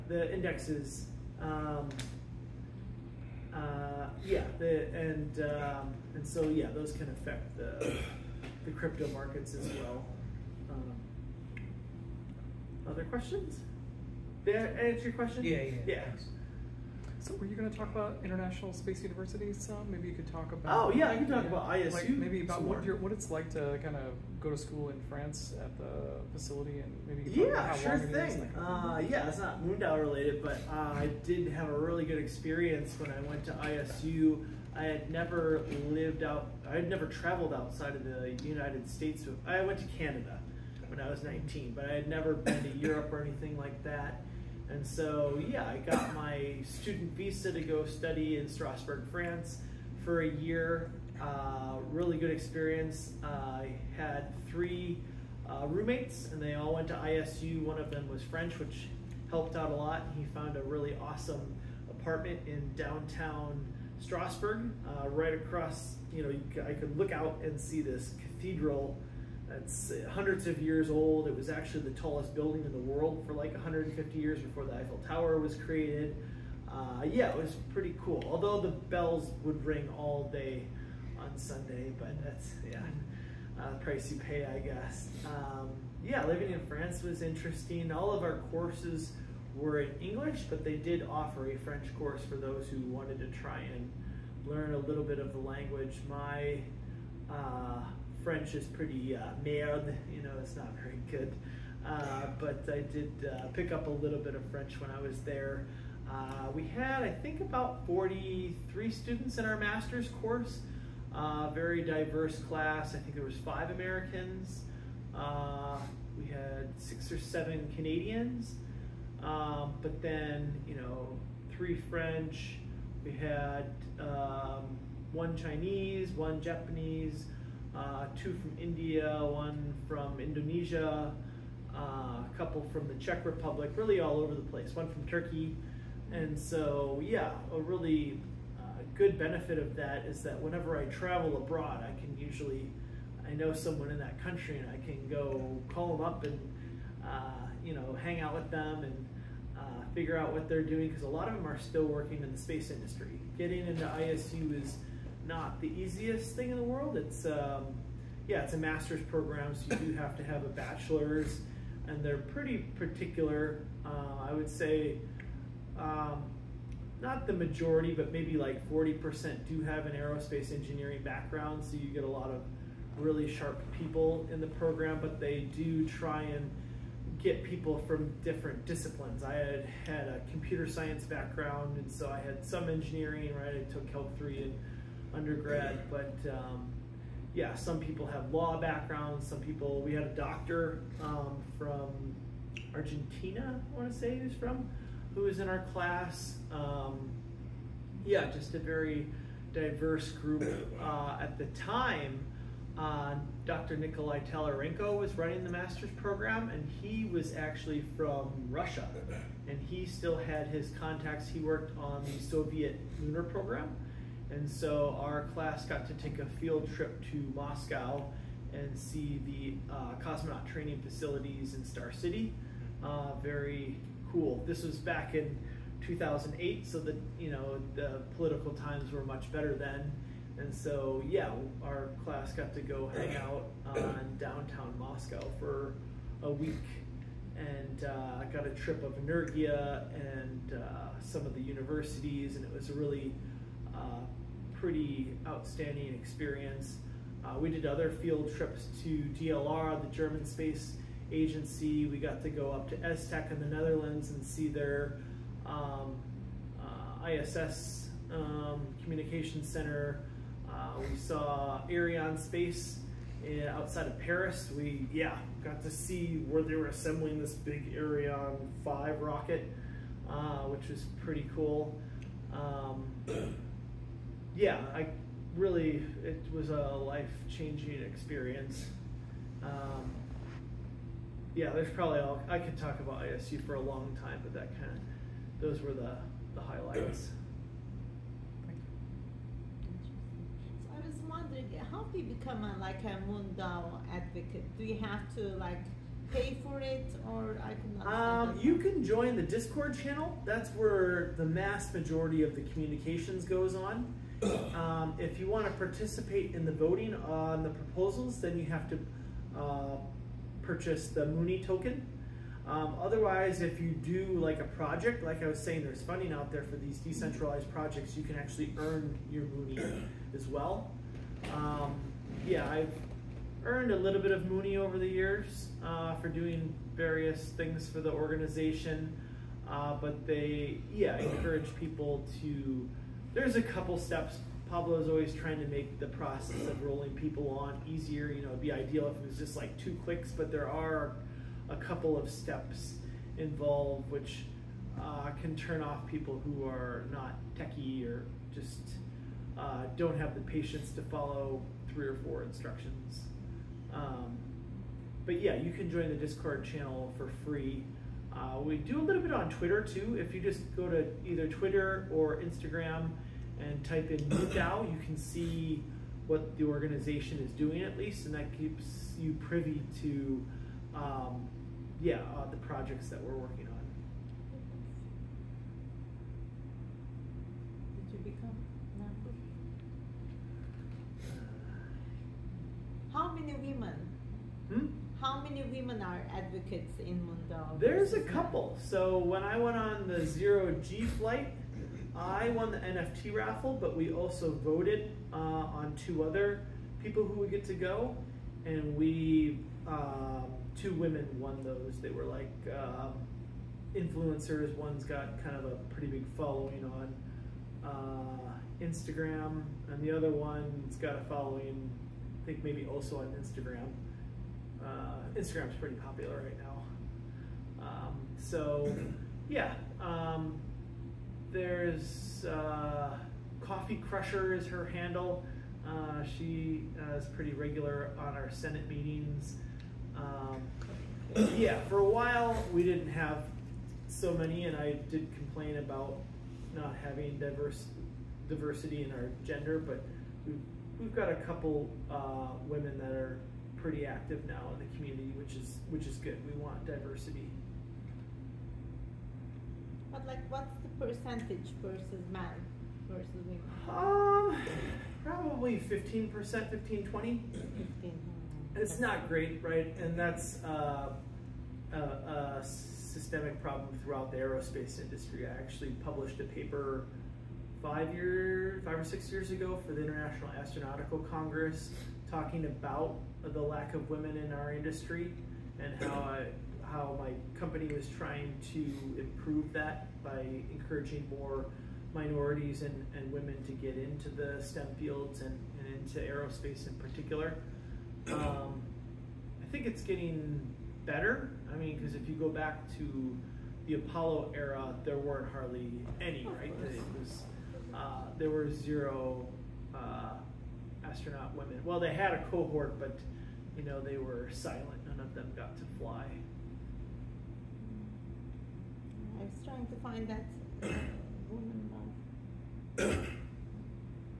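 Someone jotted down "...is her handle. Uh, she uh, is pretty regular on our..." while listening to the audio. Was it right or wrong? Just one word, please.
right.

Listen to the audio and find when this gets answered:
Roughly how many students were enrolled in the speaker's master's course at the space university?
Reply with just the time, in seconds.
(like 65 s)
107 s.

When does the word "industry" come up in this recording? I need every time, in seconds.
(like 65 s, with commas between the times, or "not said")
152 s, 464 s, 474 s.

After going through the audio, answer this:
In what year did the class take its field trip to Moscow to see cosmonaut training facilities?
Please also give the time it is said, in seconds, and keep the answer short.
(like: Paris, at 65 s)
2008, at 225 s.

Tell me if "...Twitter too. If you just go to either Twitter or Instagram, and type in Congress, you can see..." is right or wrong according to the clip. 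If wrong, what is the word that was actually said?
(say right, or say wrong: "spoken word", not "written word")
wrong: "MoonDAO", not "Congress".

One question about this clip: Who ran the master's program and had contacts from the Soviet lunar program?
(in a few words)
Nikolai Tolyarenko.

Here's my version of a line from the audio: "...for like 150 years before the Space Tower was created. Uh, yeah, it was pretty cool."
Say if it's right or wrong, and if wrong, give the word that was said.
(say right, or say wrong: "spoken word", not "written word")
wrong: "Eiffel", not "Space".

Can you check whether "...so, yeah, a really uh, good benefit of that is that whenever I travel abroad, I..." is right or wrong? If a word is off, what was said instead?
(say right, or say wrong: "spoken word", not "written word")
right.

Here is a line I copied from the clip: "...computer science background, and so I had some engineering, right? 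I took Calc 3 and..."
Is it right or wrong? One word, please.
right.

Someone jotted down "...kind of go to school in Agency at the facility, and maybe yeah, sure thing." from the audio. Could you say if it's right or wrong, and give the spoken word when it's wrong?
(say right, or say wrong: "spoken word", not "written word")
wrong: "France", not "Agency".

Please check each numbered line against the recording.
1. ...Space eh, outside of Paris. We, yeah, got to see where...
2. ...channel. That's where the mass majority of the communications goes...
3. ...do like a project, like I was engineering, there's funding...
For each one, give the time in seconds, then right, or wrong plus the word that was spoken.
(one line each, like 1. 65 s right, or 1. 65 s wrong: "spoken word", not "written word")
1. 262 s right
2. 299 s right
3. 313 s wrong: "saying", not "engineering".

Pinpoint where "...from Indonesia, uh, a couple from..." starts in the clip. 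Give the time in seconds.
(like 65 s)
129 s.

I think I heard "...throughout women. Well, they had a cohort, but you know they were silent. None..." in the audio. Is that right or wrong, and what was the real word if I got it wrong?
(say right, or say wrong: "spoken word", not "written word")
wrong: "astronaut", not "throughout".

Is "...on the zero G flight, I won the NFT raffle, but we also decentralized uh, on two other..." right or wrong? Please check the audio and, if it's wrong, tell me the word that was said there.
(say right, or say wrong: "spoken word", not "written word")
wrong: "voted", not "decentralized".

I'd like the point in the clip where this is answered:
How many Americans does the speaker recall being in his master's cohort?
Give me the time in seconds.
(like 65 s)
113 s.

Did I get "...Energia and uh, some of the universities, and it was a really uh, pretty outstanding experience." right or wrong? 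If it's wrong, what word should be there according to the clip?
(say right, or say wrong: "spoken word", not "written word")
right.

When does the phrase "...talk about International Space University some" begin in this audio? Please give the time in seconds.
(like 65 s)
17 s.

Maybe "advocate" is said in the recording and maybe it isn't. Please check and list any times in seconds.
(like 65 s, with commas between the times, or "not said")
293 s, 386 s.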